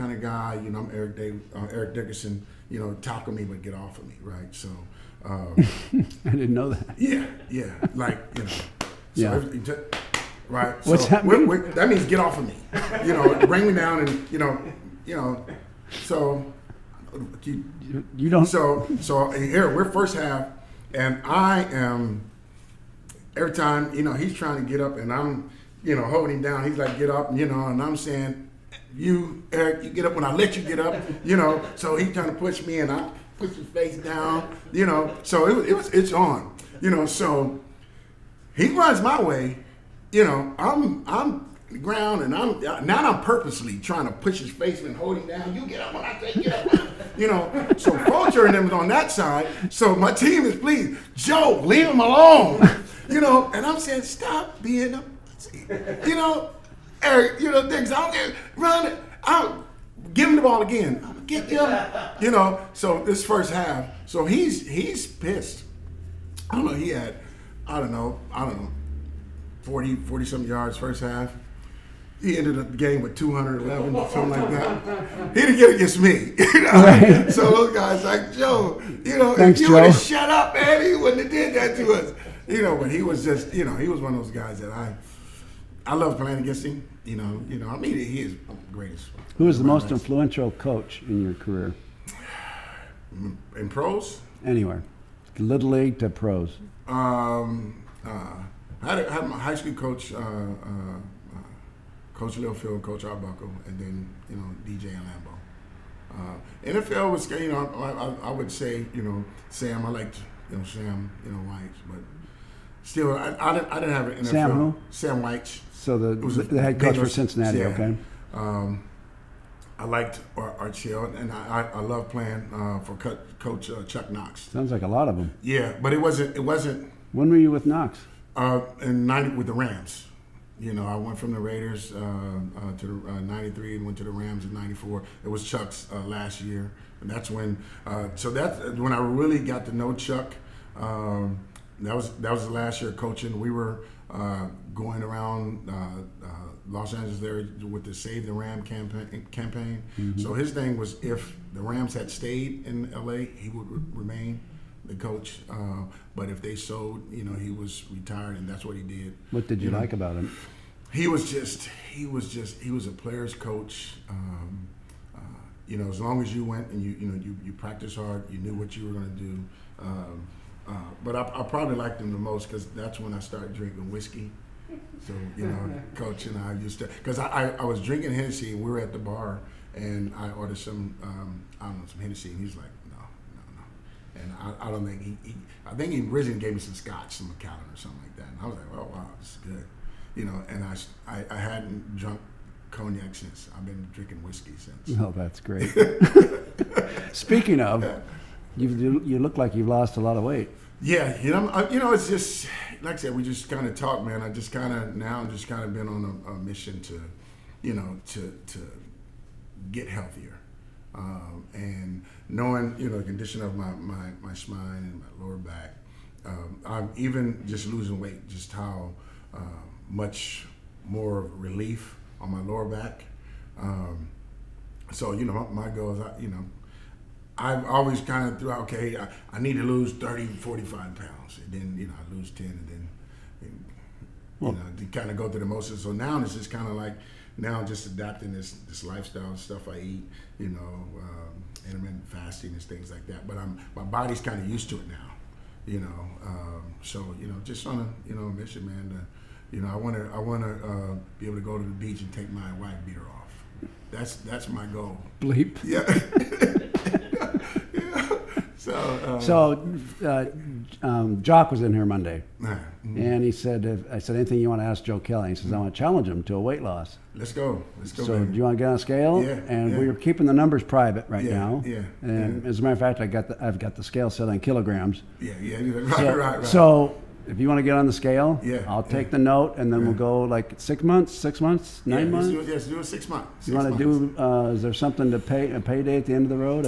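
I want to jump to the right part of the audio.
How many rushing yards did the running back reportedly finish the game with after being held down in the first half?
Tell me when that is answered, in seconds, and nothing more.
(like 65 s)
73 s.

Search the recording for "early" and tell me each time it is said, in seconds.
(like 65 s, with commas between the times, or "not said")
not said.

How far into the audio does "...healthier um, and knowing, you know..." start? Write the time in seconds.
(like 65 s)
209 s.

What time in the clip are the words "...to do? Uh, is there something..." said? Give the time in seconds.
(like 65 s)
283 s.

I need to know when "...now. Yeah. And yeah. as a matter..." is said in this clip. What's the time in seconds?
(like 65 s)
271 s.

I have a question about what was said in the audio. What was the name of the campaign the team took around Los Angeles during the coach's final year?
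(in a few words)
Save the Ram.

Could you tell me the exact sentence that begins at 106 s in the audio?
Uh, NFL was, you know, I, I, I, would say, you know, Sam.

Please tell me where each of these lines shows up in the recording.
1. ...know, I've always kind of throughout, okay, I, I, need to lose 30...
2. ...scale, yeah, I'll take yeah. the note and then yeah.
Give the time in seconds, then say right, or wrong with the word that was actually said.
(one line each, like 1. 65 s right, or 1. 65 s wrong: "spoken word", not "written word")
1. 226 s right
2. 277 s right.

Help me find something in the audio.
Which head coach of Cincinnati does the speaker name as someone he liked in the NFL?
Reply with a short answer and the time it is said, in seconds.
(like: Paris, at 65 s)
Sam Wyche, at 114 s.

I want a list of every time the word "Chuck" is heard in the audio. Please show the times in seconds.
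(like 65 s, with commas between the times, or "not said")
123 s, 135 s, 139 s.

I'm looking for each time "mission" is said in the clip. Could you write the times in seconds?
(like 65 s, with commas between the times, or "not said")
206 s, 248 s.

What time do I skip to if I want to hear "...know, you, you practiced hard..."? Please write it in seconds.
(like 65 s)
167 s.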